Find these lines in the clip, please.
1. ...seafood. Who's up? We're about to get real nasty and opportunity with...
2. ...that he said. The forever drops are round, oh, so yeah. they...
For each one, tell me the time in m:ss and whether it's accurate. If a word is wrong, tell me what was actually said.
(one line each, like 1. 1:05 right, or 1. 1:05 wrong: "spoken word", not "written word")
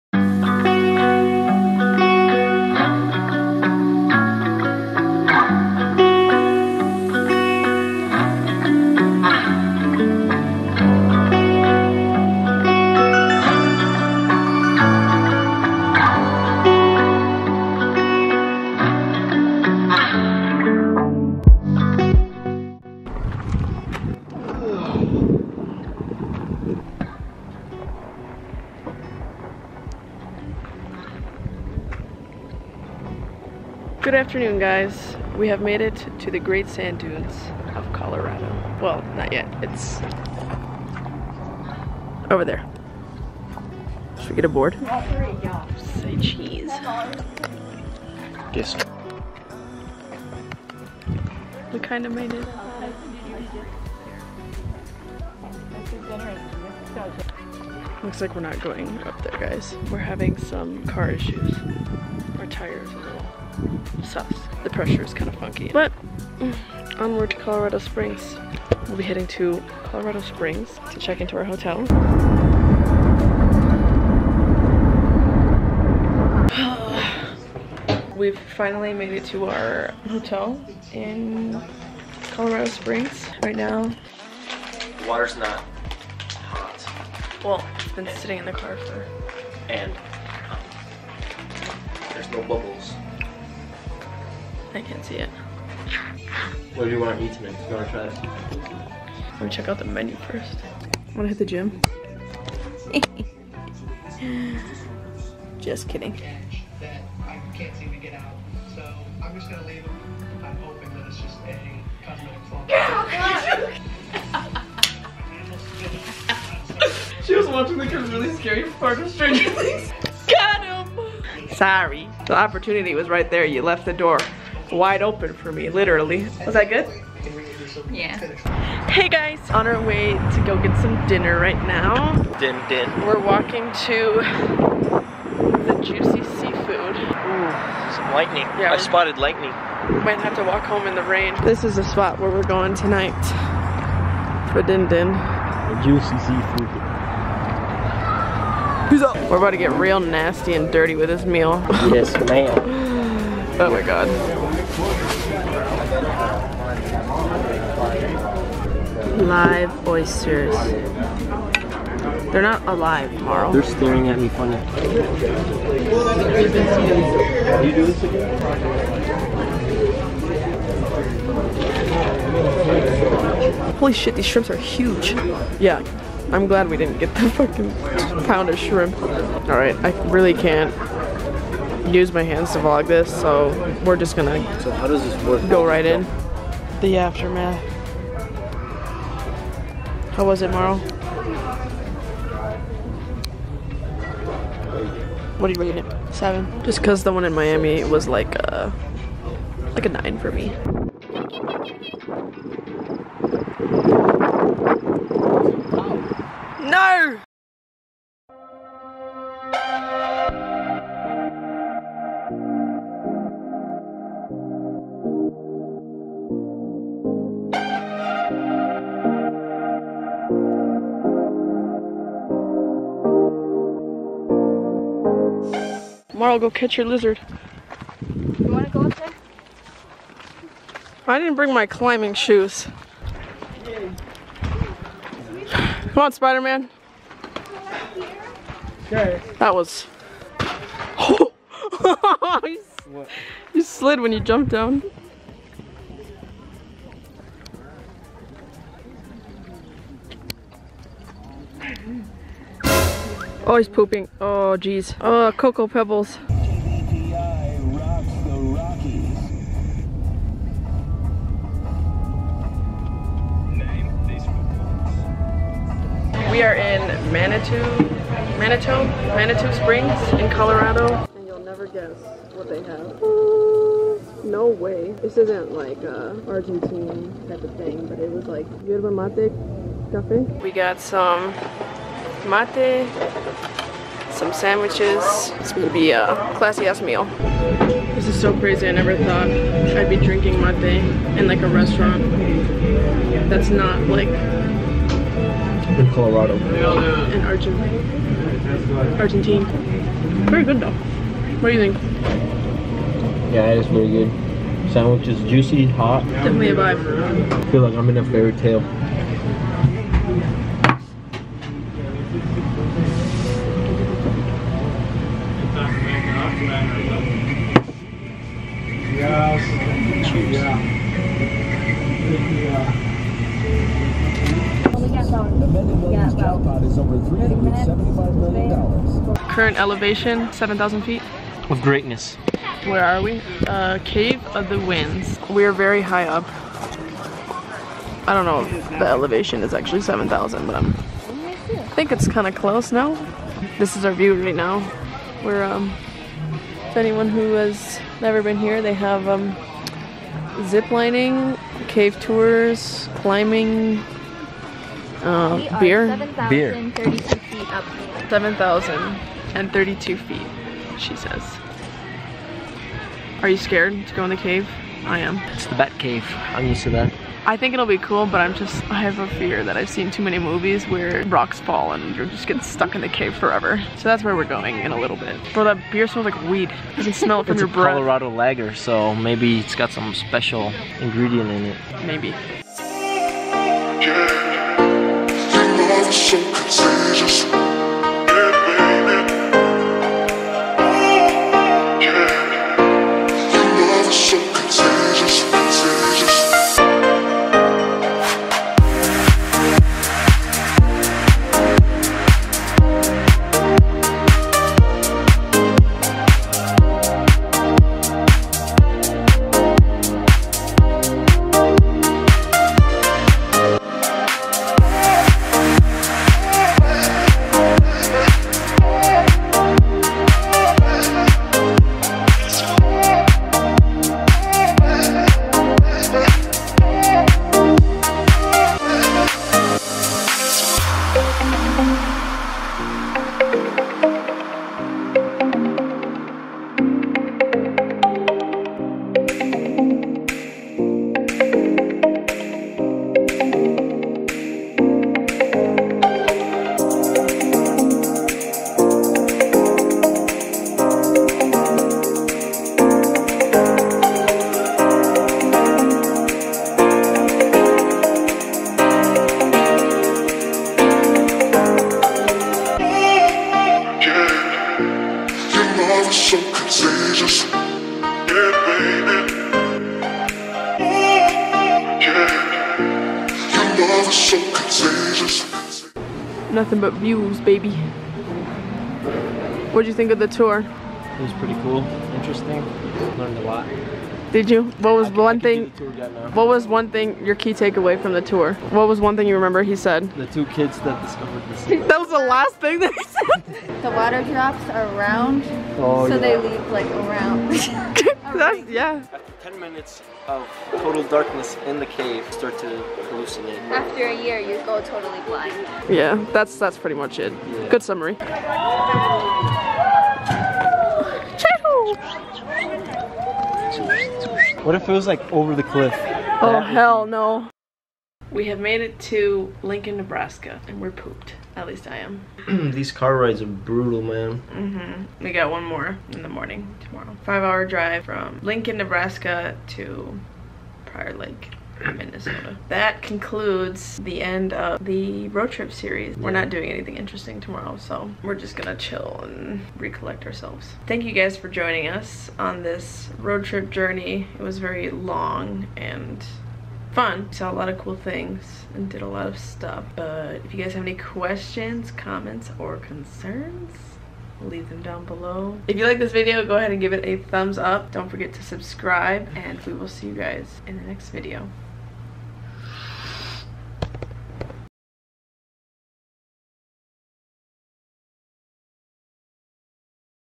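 1. 2:26 wrong: "dirty", not "opportunity"
2. 8:12 wrong: "water", not "forever".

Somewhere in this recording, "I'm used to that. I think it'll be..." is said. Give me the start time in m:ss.
6:06.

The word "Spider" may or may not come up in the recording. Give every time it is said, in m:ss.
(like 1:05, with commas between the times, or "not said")
3:56.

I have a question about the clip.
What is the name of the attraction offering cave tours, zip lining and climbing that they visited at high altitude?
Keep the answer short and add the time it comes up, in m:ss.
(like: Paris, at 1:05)
Cave of the Winds, at 5:33.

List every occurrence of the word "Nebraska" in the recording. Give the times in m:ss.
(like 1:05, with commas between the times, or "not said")
8:39, 8:48.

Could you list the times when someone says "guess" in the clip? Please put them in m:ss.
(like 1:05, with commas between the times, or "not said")
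4:31.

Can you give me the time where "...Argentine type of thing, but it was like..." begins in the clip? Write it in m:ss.
4:36.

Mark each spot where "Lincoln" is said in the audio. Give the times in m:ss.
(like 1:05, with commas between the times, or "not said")
8:39, 8:48.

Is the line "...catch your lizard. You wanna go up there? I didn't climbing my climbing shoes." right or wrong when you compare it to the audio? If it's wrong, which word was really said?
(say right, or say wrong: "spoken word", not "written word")
wrong: "bring", not "climbing".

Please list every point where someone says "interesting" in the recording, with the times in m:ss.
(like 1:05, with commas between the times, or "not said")
8:01, 8:56.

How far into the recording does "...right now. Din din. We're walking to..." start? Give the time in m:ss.
2:11.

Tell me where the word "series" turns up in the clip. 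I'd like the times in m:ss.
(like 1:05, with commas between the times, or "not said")
8:55.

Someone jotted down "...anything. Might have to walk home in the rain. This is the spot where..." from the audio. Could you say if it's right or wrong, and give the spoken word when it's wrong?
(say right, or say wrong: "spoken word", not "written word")
wrong: "lightning", not "anything".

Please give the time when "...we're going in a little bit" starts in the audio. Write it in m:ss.
6:14.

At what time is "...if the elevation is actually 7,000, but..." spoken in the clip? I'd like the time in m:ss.
5:38.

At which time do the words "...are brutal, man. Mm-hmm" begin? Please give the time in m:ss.
8:43.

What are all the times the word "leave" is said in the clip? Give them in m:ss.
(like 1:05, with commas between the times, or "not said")
8:16, 9:14.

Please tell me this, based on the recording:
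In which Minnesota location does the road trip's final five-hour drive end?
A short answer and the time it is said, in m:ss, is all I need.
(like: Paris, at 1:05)
Prior Lake, at 8:50.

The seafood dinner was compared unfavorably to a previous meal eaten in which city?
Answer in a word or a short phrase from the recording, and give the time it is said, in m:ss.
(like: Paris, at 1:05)
Miami, at 3:17.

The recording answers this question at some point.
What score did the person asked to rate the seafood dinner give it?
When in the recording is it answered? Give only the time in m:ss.
3:16.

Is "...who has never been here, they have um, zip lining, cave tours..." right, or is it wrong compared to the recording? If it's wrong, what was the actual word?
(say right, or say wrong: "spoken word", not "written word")
right.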